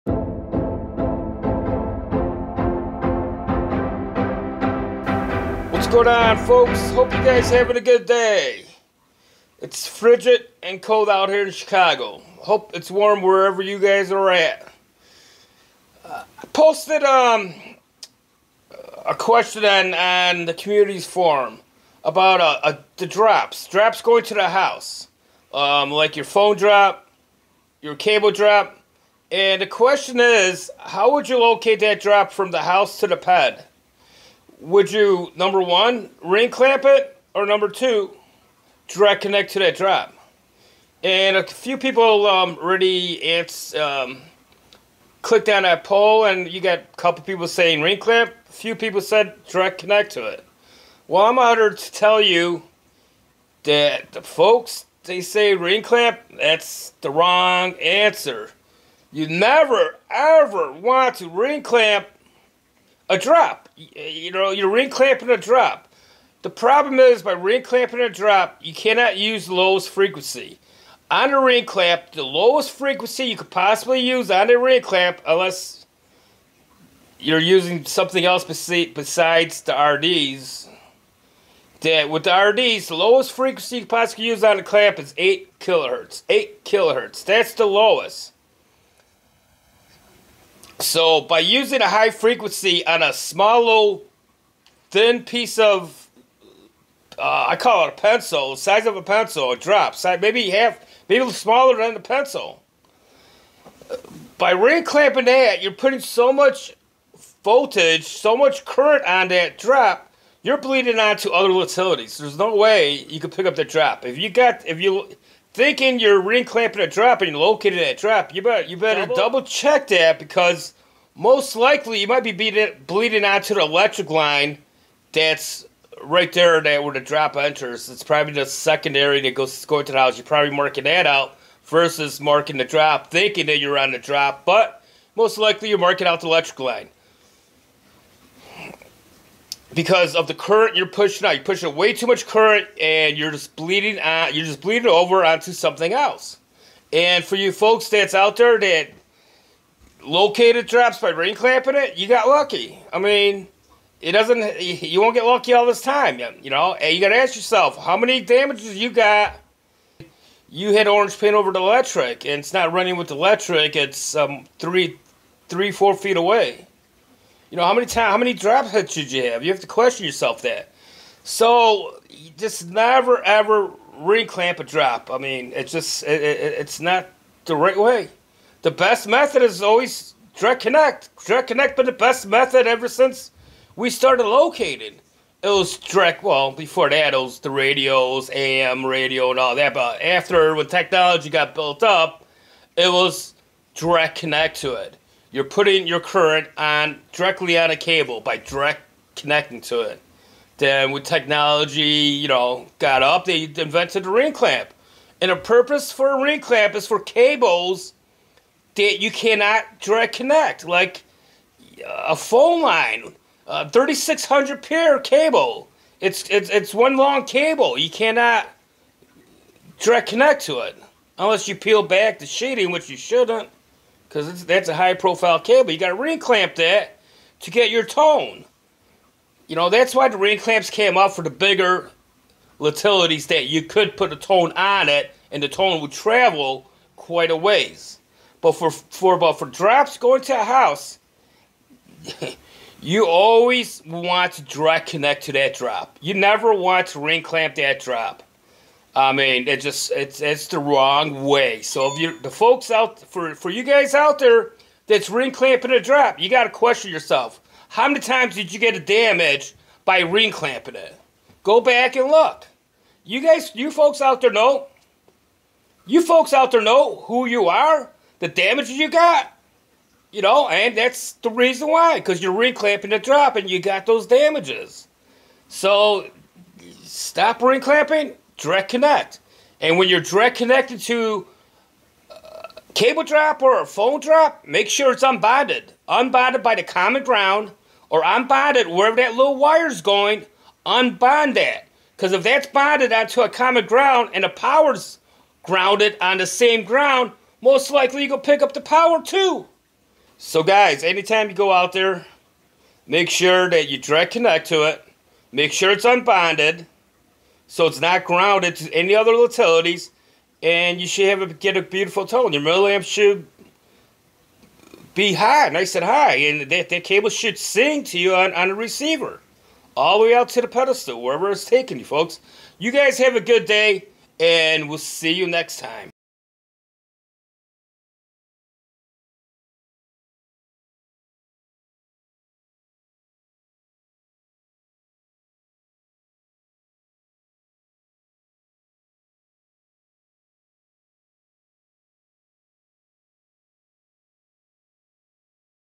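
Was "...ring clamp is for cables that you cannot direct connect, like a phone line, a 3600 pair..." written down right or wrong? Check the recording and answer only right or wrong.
right.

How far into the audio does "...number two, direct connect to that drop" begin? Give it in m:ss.
0:37.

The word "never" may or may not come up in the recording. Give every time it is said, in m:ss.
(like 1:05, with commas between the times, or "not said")
0:59, 2:52, 4:06.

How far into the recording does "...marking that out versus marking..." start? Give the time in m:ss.
2:10.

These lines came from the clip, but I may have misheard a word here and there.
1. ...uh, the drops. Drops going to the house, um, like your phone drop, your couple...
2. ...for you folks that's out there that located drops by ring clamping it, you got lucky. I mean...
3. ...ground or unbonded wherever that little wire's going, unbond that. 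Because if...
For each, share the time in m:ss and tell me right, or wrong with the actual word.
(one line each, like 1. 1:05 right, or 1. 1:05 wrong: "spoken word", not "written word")
1. 0:22 wrong: "cable", not "couple"
2. 2:27 right
3. 4:47 right.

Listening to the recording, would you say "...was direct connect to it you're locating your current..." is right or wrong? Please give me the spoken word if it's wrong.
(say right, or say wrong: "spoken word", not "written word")
wrong: "putting", not "locating".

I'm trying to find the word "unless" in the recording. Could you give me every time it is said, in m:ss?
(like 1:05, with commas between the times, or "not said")
1:15, 3:41.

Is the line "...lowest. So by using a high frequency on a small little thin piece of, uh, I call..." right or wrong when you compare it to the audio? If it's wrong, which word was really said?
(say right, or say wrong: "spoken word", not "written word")
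right.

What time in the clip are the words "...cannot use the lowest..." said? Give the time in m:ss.
1:08.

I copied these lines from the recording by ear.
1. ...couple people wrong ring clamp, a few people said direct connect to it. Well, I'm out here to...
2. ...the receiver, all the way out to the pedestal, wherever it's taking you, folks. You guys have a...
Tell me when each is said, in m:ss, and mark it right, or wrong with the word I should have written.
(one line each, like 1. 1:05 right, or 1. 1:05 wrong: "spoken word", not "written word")
1. 0:46 wrong: "saying", not "wrong"
2. 5:18 right.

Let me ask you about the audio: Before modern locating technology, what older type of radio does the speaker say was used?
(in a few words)
AM radio.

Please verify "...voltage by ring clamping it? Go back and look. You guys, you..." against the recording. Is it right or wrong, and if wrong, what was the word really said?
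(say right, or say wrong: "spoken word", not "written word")
wrong: "damage", not "voltage".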